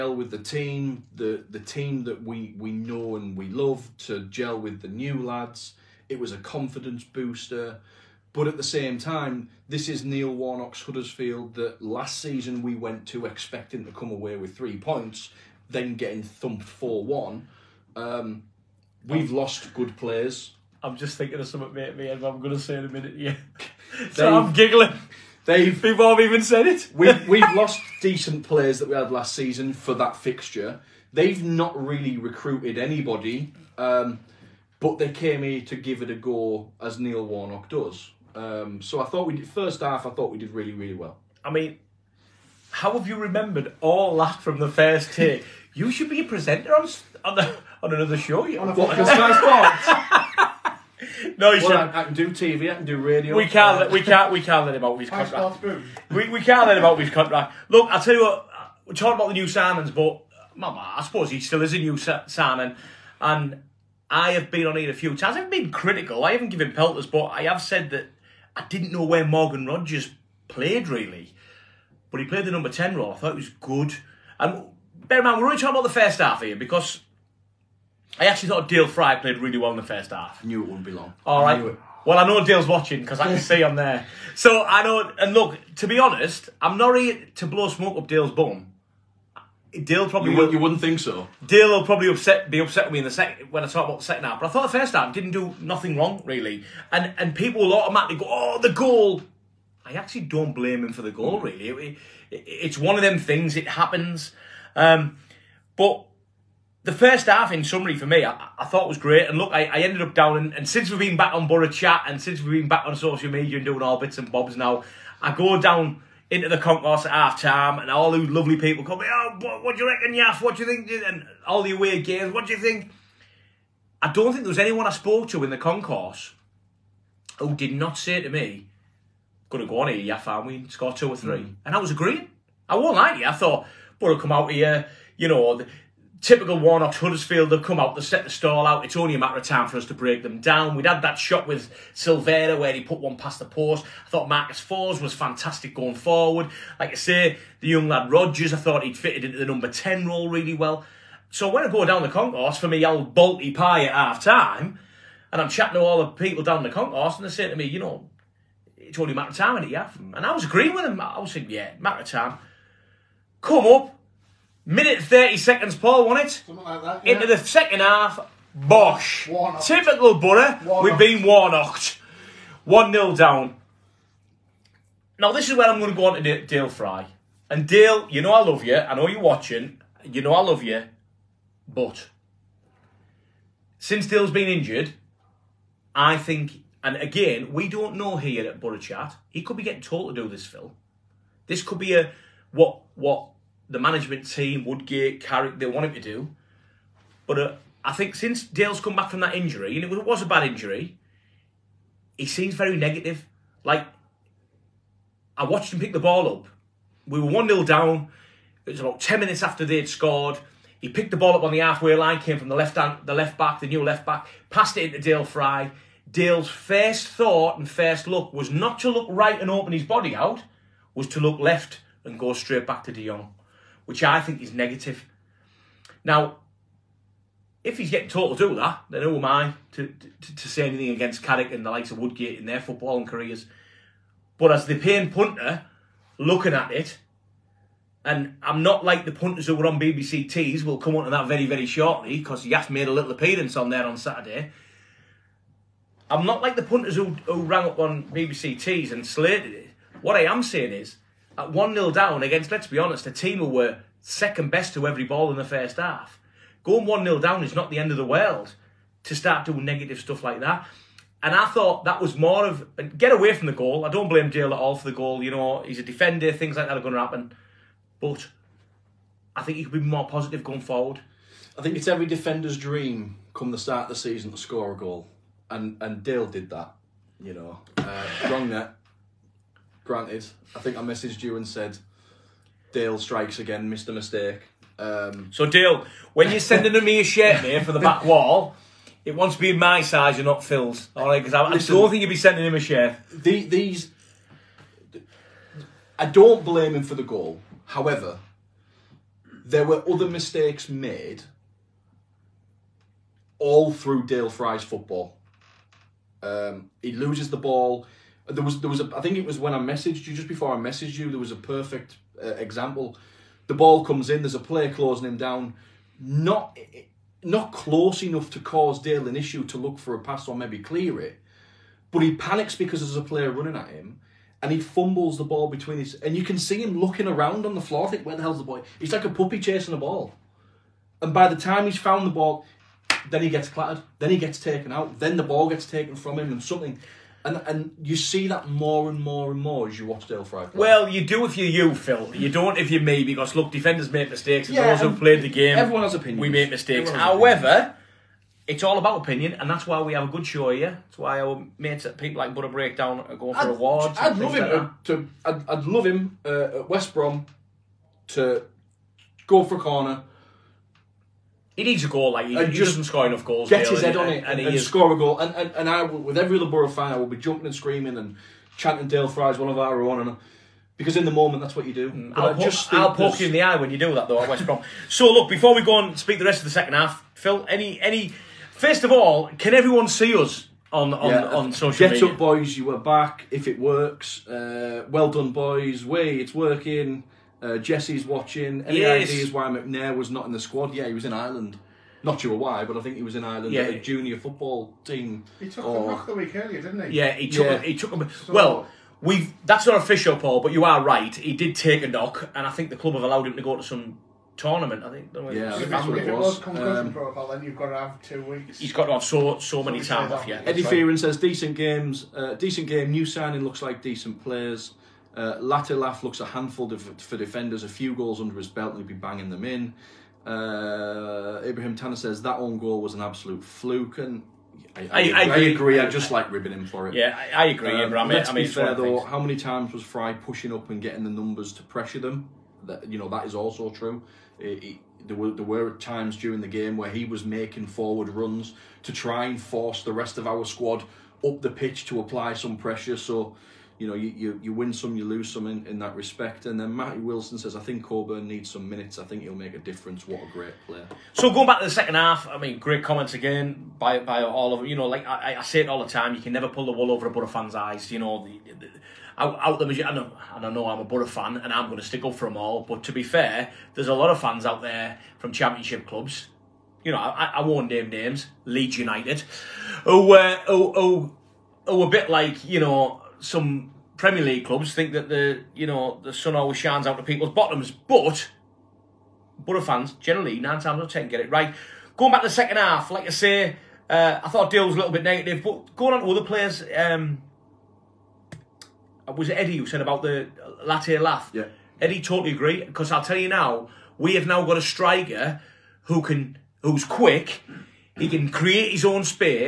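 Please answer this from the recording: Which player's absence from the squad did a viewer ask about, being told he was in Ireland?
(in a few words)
McNair.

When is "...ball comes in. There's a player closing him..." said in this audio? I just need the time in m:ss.
5:13.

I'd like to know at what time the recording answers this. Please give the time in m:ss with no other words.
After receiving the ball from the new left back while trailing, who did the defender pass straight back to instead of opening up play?
3:42.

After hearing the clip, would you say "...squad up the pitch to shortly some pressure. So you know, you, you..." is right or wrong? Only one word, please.
wrong.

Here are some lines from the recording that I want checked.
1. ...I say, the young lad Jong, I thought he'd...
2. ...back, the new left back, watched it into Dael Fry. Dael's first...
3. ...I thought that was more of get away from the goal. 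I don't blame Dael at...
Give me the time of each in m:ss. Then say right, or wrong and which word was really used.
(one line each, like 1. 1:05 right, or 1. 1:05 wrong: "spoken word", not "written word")
1. 2:26 wrong: "Rogers", not "Jong"
2. 3:33 wrong: "passed", not "watched"
3. 4:21 right.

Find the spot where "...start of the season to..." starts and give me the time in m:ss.
4:33.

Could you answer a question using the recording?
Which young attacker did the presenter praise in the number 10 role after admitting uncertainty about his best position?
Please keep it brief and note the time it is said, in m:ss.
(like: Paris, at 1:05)
Morgan Rogers, at 1:09.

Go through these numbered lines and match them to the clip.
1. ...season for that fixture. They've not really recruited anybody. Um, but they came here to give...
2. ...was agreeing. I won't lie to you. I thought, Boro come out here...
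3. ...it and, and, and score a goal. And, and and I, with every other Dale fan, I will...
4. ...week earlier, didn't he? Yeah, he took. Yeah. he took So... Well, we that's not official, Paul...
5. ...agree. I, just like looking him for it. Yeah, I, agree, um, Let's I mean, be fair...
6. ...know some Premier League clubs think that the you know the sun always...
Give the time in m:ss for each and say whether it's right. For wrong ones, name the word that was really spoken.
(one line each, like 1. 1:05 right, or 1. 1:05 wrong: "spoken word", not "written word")
1. 0:29 right
2. 2:11 right
3. 6:04 wrong: "Boro", not "Dale"
4. 6:36 right
5. 7:05 wrong: "ribbing", not "looking"
6. 7:52 right.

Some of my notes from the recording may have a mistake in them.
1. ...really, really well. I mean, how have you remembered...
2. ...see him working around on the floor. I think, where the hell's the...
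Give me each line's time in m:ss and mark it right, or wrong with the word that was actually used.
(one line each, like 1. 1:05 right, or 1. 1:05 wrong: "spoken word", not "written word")
1. 0:40 right
2. 5:26 wrong: "looking", not "working".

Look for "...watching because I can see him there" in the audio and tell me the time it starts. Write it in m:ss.
1:22.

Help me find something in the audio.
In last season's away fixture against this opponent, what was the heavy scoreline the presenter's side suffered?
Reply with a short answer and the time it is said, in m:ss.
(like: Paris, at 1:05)
4-1, at 0:16.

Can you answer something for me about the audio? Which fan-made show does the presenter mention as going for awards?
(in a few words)
Boro Breakdown.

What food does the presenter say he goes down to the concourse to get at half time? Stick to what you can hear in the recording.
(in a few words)
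Bolty pie.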